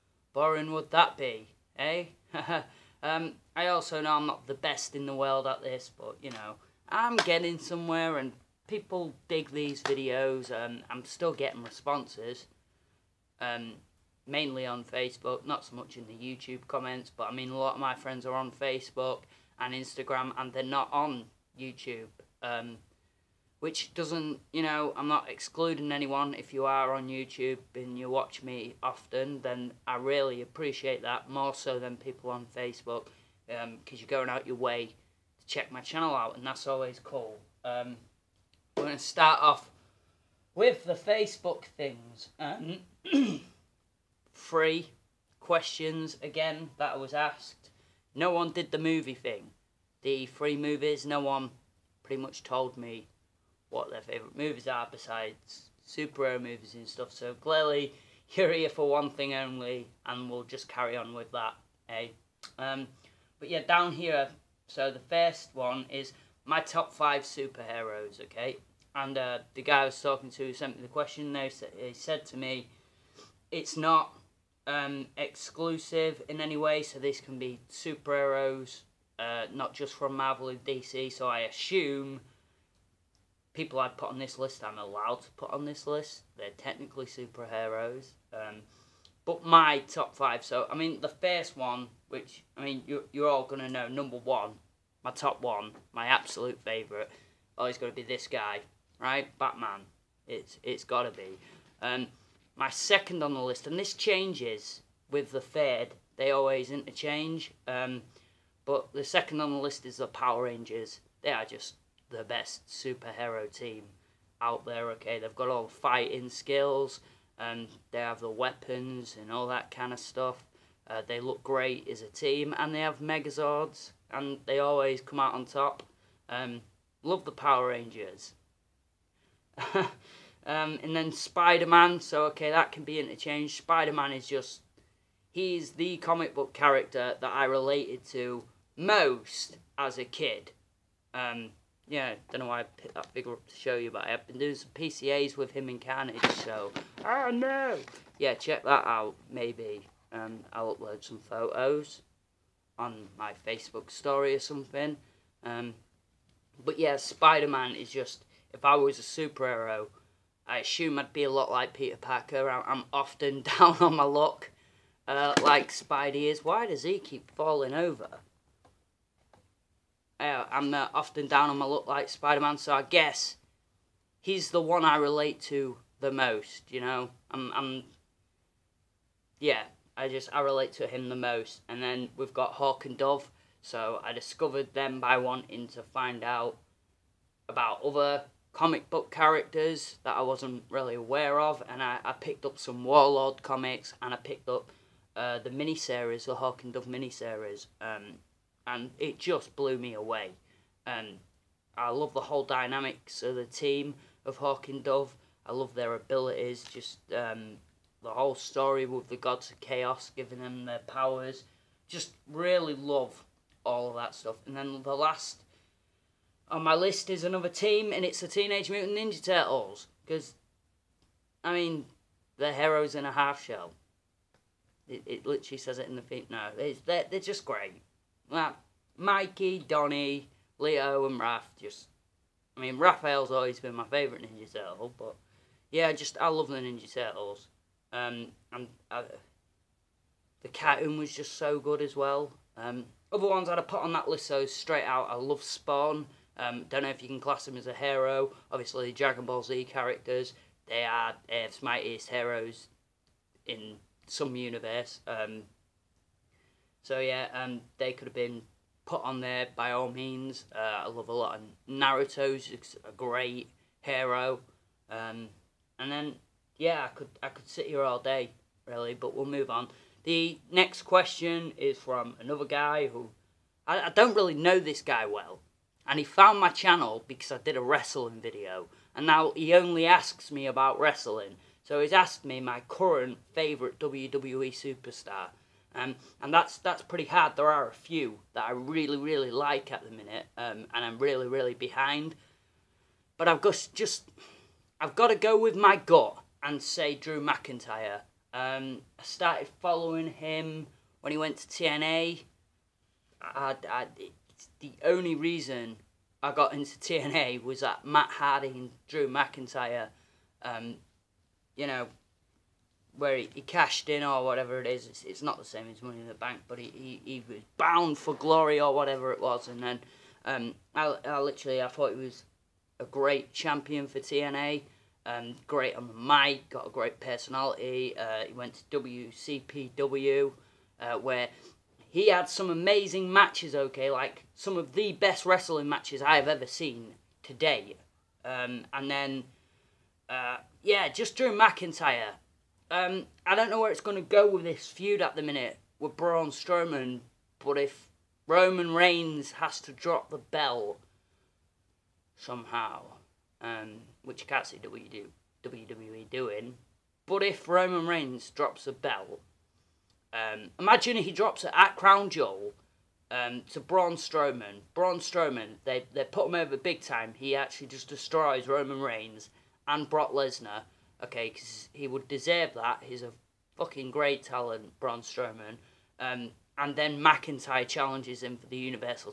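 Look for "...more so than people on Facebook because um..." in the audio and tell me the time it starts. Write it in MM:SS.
00:31.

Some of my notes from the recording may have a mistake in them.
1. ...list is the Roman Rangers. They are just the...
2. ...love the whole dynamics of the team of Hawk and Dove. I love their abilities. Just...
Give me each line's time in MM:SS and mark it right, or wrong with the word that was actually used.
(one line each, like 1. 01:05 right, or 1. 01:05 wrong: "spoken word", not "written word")
1. 01:49 wrong: "Power", not "Roman"
2. 03:21 right.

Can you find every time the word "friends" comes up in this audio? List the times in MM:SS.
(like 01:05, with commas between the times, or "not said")
00:17.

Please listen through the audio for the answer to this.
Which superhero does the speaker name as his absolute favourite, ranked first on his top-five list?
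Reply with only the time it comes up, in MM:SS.
01:39.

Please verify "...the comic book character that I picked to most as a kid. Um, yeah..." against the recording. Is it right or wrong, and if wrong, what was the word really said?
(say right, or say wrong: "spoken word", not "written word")
wrong: "related", not "picked".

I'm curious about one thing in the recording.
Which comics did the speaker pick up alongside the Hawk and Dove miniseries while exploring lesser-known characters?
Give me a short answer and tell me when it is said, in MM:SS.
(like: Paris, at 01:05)
Warlord, at 03:12.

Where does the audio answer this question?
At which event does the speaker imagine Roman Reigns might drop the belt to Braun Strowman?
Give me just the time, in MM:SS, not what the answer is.
06:01.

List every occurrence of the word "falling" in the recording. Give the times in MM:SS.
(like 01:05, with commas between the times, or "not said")
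02:47.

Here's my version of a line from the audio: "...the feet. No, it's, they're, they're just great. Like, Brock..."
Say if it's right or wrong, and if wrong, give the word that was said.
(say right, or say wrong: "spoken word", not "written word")
wrong: "Mikey", not "Brock".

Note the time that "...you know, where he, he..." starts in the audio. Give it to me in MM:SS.
05:11.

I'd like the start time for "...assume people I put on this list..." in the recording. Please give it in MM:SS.
01:21.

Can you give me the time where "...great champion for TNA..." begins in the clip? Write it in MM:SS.
05:22.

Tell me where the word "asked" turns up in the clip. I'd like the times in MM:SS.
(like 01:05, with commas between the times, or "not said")
00:47, 04:41.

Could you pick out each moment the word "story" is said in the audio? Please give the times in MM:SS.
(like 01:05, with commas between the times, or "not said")
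02:33, 03:28.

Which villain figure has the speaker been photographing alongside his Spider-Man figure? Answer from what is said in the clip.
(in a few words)
Carnage.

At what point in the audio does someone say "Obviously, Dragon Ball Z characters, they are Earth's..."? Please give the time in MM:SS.
04:08.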